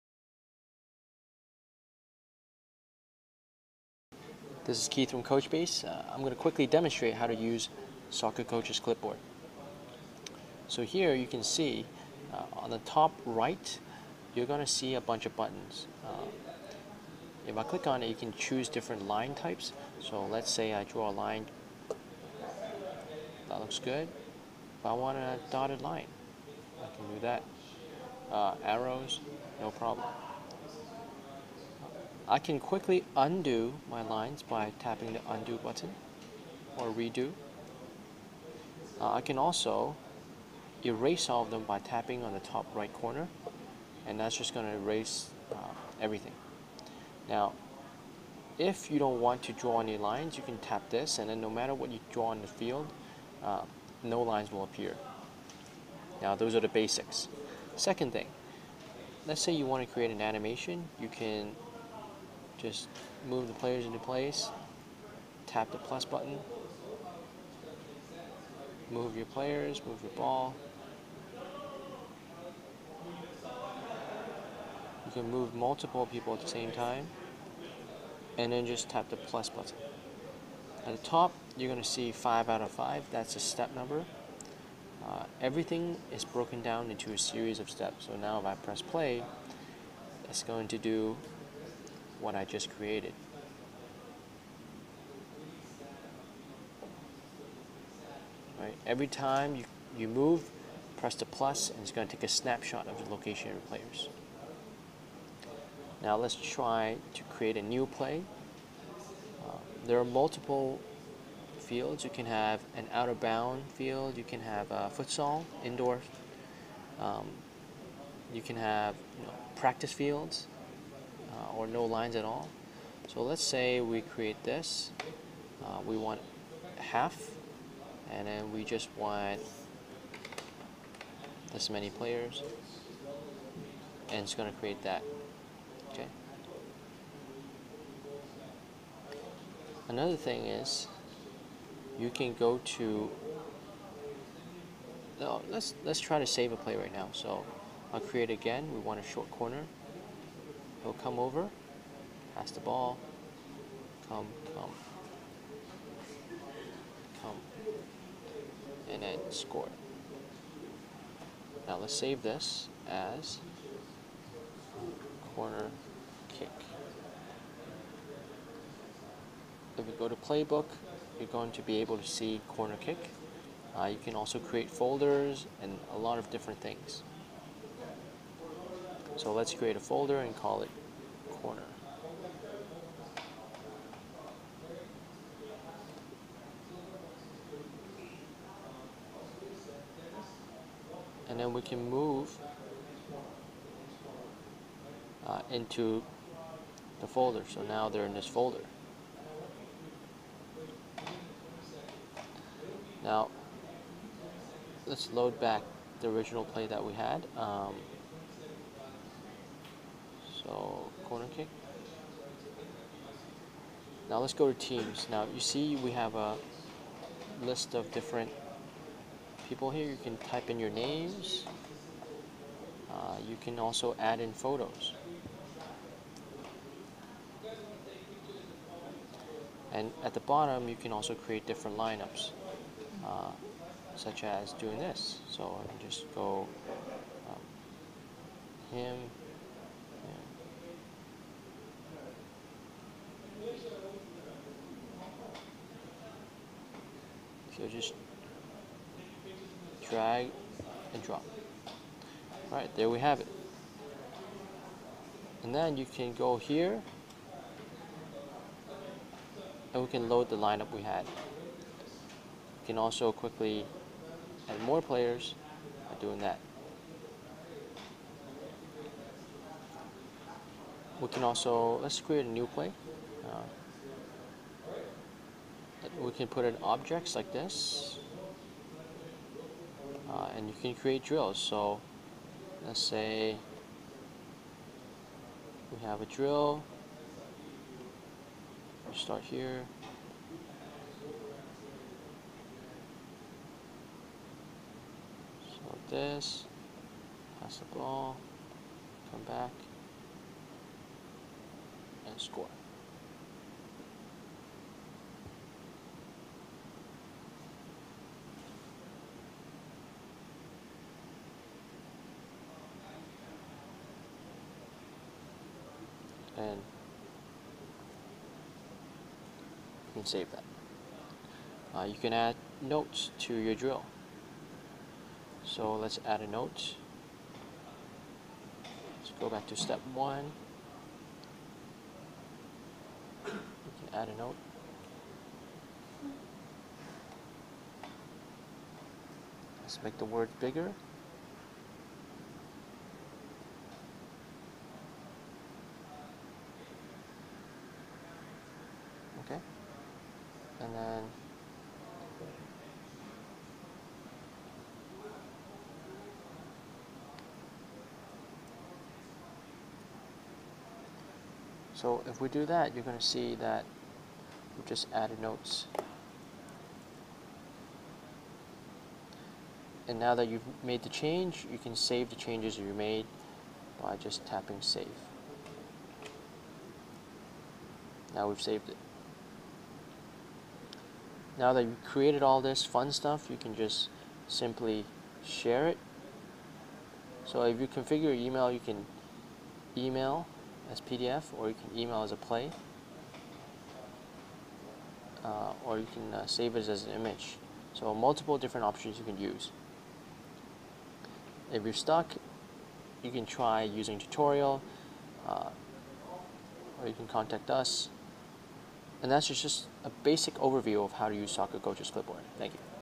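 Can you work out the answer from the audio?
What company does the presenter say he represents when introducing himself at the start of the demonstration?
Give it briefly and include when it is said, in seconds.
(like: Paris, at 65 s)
CoachBase, at 5 s.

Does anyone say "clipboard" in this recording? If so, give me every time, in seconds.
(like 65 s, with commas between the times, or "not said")
8 s, 411 s.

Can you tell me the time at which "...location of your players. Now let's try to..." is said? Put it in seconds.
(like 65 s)
103 s.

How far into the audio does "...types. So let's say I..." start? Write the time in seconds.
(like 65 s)
19 s.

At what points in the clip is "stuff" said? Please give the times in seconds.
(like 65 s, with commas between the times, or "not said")
382 s.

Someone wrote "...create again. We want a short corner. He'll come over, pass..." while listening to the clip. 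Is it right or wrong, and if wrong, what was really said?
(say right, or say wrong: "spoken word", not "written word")
right.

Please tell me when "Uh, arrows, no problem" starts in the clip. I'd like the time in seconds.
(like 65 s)
28 s.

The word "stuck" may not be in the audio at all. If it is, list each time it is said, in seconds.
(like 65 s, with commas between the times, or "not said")
401 s.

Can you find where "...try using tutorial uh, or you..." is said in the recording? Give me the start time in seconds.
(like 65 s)
403 s.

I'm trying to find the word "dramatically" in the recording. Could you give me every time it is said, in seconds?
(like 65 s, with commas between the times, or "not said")
not said.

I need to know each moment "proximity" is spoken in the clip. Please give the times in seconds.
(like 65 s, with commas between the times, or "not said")
not said.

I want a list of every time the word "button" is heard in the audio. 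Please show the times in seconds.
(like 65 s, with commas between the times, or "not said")
15 s, 35 s, 66 s, 79 s.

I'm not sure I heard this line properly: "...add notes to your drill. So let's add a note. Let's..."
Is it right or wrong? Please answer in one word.
right.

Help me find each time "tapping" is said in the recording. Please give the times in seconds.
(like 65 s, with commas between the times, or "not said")
34 s, 41 s, 374 s.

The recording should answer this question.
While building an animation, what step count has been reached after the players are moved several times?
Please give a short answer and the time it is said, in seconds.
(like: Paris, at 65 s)
5 out of 5, at 82 s.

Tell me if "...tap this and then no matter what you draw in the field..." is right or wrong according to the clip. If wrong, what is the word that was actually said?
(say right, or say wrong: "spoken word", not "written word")
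right.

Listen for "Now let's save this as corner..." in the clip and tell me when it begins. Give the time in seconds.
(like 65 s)
161 s.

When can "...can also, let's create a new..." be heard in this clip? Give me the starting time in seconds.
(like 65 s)
271 s.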